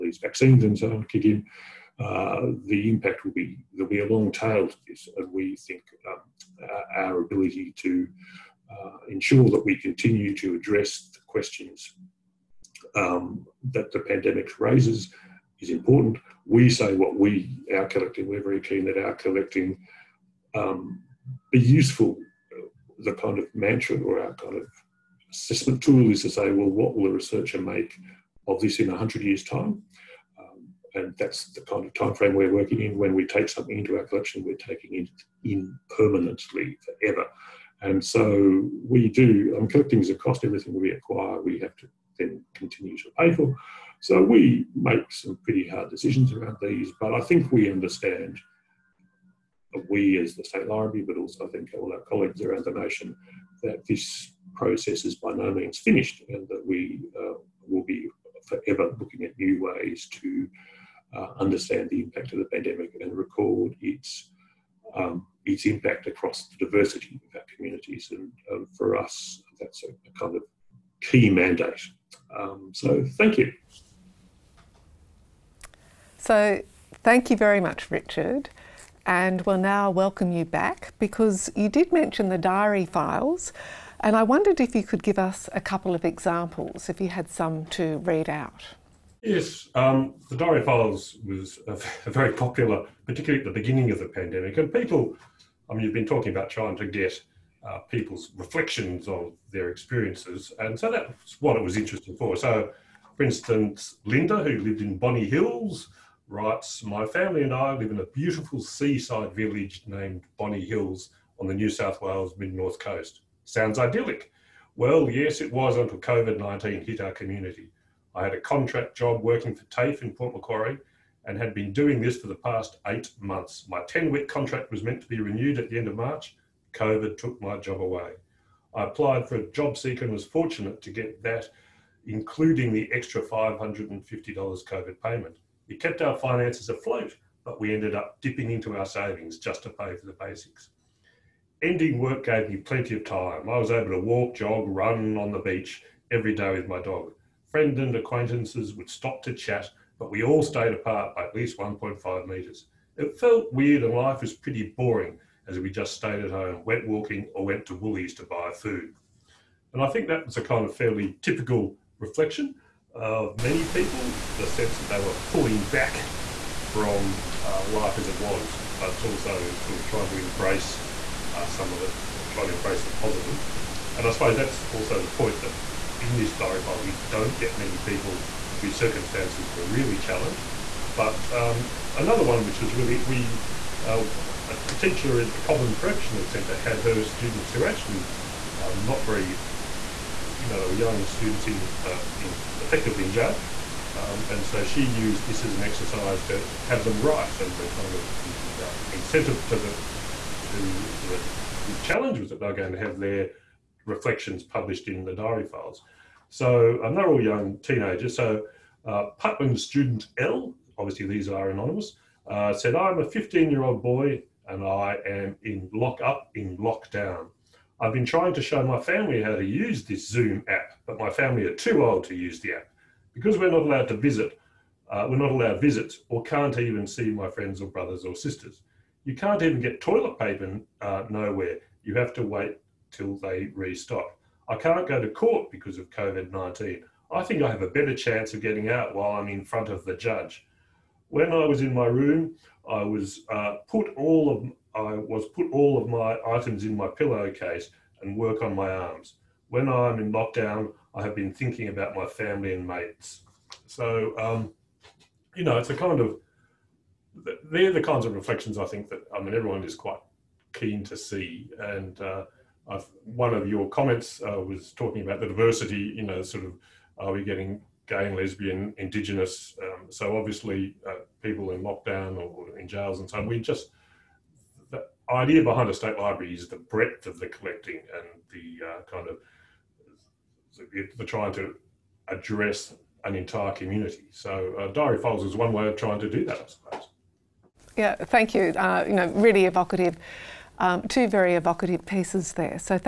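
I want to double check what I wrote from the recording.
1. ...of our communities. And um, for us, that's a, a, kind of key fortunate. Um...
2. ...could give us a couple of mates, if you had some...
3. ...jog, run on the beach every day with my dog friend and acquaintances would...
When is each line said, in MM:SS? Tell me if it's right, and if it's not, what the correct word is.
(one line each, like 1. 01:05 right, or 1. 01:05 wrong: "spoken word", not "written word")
1. 01:07 wrong: "mandate", not "fortunate"
2. 01:24 wrong: "examples", not "mates"
3. 02:24 right.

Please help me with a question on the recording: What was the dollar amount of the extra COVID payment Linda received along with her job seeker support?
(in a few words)
$550.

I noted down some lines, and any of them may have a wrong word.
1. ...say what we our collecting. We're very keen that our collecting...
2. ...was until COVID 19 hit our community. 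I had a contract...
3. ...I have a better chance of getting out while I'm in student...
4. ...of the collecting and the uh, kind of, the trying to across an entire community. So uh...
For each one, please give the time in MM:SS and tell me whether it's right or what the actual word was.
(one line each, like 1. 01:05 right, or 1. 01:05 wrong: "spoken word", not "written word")
1. 00:16 right
2. 01:55 right
3. 03:57 wrong: "front", not "student"
4. 04:37 wrong: "address", not "across".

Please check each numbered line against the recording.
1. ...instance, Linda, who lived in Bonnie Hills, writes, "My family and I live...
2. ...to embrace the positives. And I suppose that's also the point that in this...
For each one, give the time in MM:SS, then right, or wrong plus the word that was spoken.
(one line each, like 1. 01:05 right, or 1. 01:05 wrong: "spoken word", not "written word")
1. 01:43 right
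2. 02:52 right.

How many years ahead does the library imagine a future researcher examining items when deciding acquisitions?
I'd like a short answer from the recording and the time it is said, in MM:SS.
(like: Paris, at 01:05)
100 years, at 00:28.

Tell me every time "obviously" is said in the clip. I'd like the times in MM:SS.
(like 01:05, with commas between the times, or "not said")
03:30, 04:30.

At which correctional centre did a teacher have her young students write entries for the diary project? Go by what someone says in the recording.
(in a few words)
Cobham Correctional Centre.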